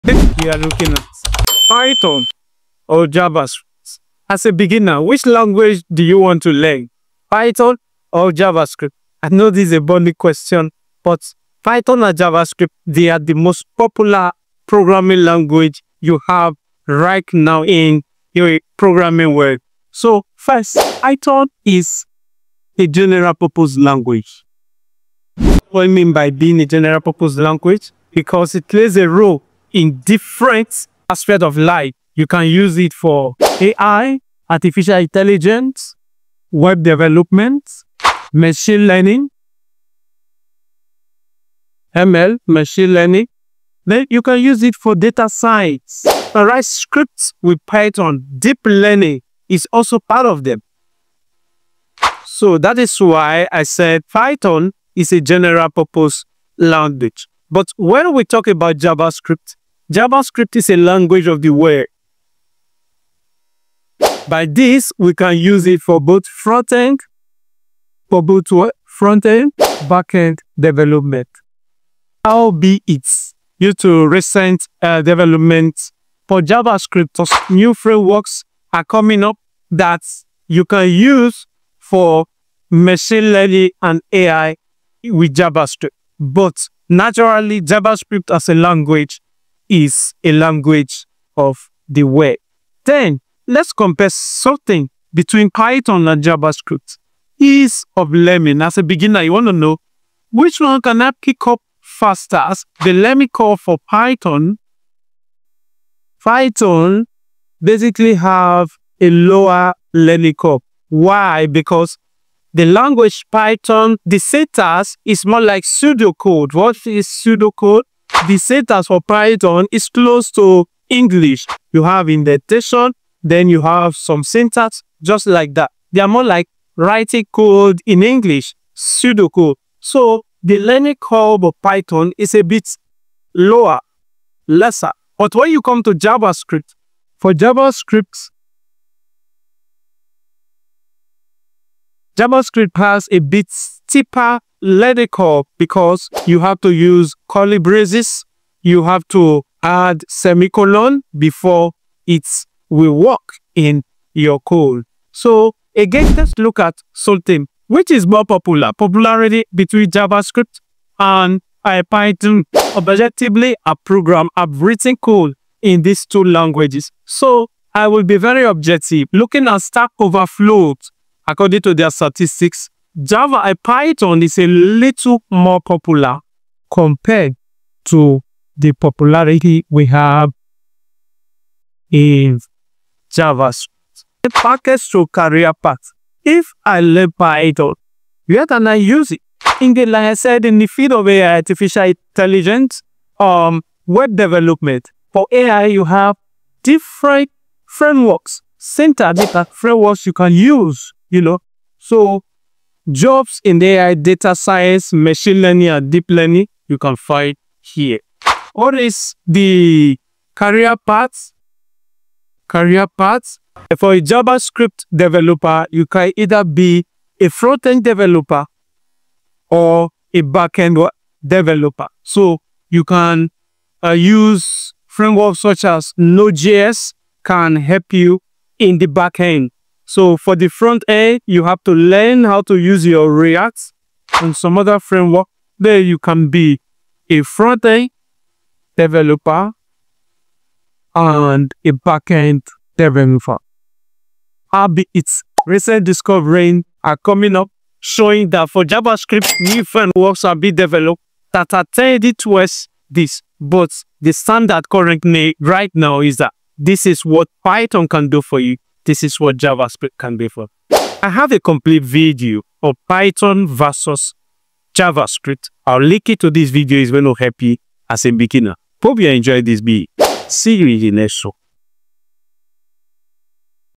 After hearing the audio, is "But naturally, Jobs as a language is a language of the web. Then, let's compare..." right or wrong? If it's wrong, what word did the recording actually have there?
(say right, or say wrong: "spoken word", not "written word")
wrong: "JavaScript", not "Jobs".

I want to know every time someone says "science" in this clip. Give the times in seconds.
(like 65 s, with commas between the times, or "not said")
45 s, 204 s.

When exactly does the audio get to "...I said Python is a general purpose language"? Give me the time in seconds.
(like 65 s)
53 s.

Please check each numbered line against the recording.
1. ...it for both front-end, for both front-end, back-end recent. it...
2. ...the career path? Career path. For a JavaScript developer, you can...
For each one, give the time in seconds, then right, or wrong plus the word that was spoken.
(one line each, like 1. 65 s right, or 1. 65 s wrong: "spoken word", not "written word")
1. 65 s wrong: "development", not "recent"
2. 209 s right.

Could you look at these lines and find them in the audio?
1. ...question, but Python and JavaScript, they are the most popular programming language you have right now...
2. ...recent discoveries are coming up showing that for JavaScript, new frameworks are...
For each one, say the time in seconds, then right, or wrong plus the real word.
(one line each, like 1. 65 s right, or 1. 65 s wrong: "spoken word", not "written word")
1. 10 s right
2. 245 s right.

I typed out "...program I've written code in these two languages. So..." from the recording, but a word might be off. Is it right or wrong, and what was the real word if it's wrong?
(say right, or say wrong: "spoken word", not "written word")
right.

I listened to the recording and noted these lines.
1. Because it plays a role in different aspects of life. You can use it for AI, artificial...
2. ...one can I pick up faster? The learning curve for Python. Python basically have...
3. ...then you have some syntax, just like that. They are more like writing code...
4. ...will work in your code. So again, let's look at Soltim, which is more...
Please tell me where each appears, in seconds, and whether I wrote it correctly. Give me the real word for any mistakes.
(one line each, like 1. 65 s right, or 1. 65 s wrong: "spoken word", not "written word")
1. 28 s right
2. 100 s right
3. 123 s right
4. 152 s right.